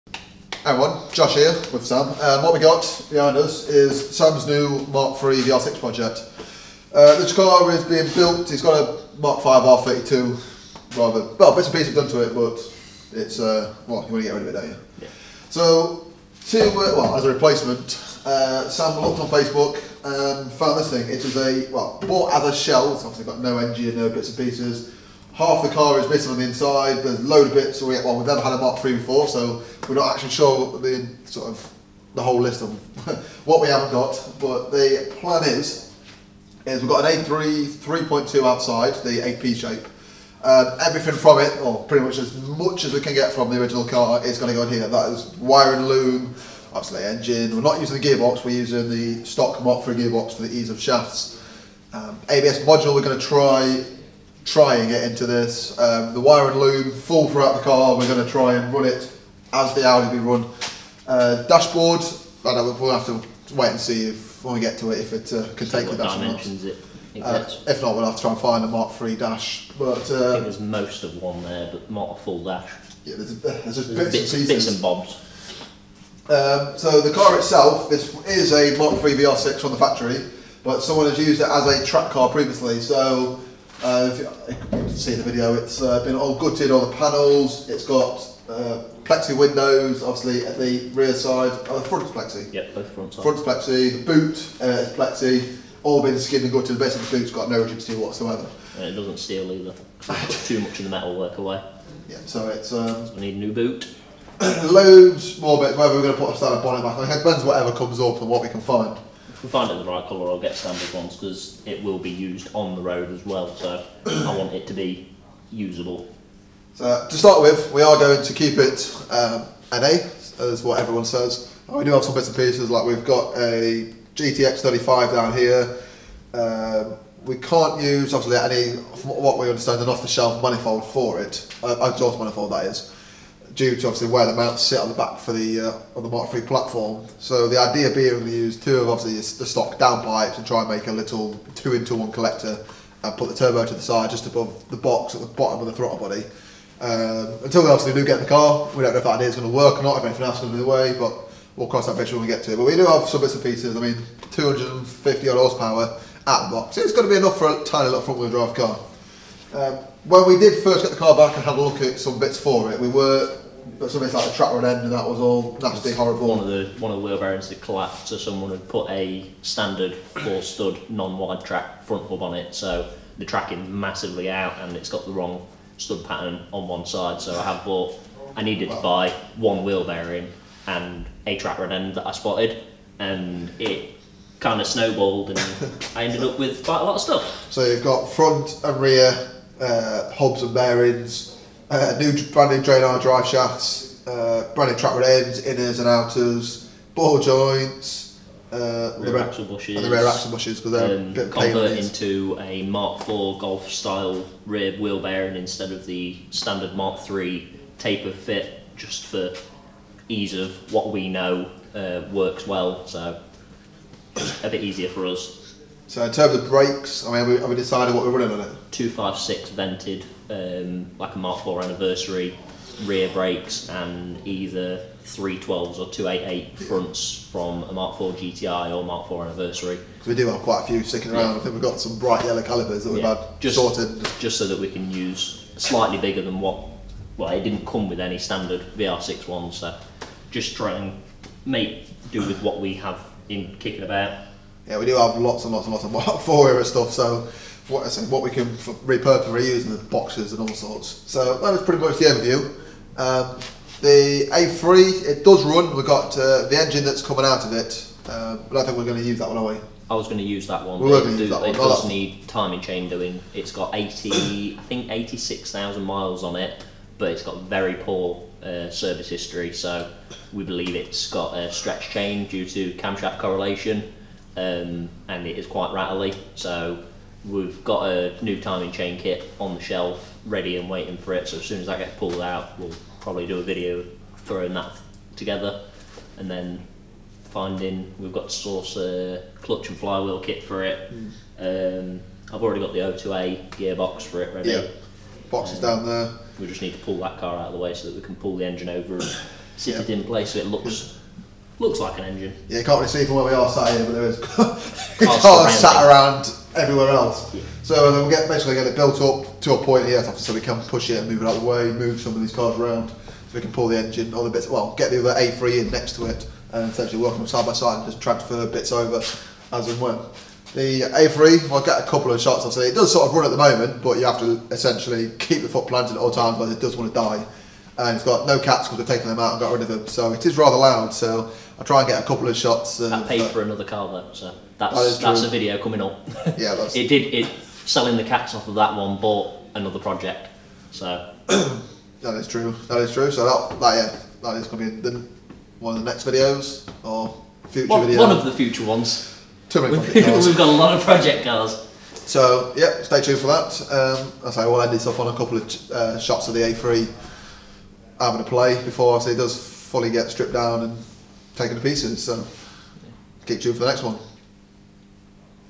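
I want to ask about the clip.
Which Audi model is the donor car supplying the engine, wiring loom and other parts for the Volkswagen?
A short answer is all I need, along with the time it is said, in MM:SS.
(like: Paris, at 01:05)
A3 3.2, at 00:37.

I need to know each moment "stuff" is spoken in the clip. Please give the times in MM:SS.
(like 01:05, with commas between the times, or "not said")
03:07, 04:06.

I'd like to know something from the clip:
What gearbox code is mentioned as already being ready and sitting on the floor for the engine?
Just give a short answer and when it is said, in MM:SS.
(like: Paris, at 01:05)
02A, at 04:52.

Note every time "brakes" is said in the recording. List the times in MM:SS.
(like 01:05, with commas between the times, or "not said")
03:36, 03:43.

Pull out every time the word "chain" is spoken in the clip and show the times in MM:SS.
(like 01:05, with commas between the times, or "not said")
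04:22, 04:31, 04:38.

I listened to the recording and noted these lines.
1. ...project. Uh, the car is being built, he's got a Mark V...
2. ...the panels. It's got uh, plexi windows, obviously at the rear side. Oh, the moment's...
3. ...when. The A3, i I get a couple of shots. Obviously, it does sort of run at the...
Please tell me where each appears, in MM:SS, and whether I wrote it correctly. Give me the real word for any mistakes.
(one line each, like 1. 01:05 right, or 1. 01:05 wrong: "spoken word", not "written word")
1. 00:05 right
2. 01:26 wrong: "front", not "moment"
3. 05:19 right.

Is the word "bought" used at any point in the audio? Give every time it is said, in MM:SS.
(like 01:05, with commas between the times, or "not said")
00:22, 02:57, 05:38.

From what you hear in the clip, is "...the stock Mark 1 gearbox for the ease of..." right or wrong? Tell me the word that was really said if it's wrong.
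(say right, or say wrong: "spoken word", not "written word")
wrong: "3", not "1".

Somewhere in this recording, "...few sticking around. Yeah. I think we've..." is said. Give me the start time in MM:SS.
03:50.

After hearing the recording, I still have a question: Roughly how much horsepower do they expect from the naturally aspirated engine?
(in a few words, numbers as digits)
250.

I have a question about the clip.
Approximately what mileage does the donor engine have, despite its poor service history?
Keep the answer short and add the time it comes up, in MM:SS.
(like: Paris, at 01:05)
86,000 miles, at 04:24.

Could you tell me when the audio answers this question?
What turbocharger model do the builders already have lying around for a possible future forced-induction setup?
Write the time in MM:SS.
02:04.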